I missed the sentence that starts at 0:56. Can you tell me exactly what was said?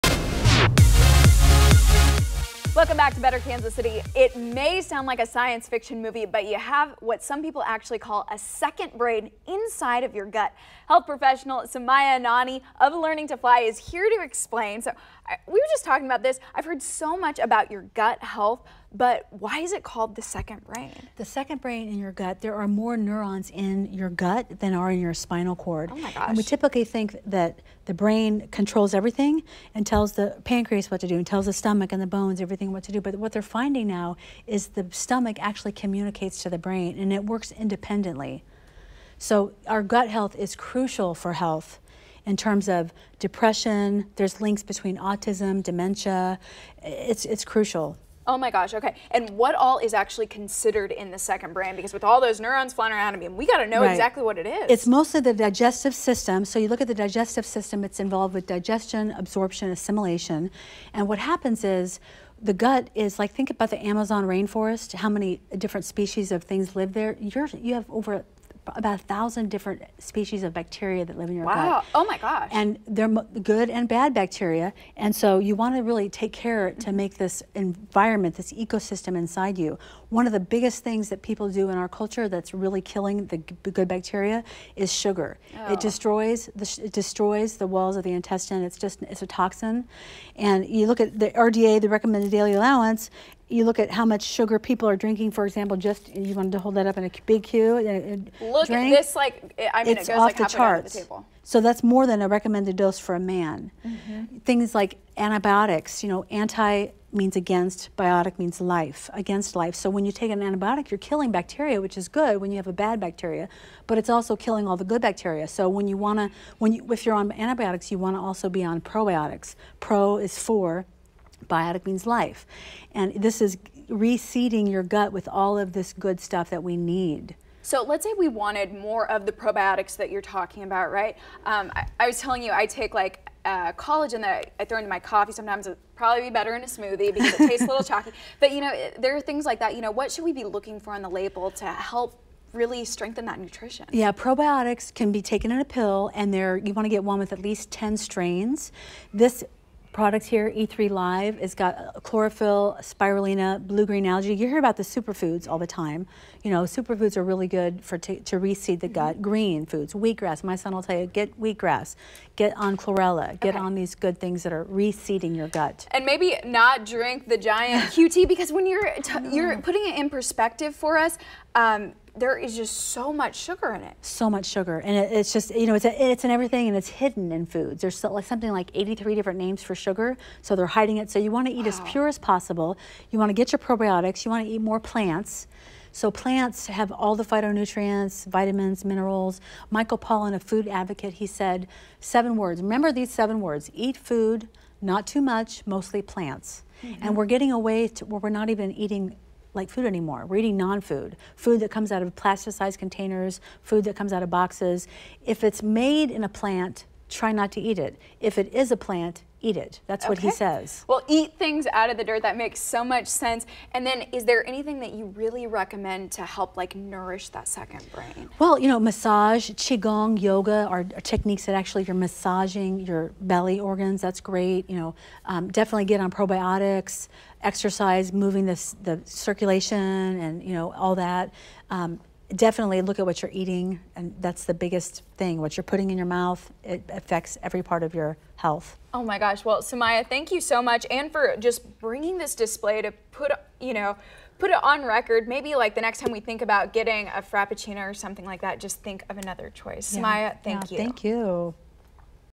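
So you look at the digestive system, it's involved with digestion, absorption, assimilation.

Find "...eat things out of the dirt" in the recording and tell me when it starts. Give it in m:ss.
3:31.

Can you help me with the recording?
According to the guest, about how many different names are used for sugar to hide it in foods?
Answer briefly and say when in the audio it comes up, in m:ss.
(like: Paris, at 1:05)
83, at 2:58.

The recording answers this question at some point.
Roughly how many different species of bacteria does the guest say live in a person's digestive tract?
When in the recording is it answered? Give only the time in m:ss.
1:08.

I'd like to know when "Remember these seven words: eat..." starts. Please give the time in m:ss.
3:12.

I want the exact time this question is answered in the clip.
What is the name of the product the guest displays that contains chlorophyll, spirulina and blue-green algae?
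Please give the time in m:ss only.
2:30.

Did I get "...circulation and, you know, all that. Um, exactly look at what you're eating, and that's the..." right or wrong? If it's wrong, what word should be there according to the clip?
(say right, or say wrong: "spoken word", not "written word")
wrong: "definitely", not "exactly".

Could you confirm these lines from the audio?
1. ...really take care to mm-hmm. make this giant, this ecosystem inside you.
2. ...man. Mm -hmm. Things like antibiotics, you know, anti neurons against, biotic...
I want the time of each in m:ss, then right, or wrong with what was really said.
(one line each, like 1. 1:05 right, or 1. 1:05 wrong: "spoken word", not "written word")
1. 1:15 wrong: "environment", not "giant"
2. 1:43 wrong: "means", not "neurons".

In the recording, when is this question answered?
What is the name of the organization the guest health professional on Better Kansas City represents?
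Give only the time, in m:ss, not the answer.
0:12.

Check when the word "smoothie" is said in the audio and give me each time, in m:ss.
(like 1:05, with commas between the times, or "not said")
2:16.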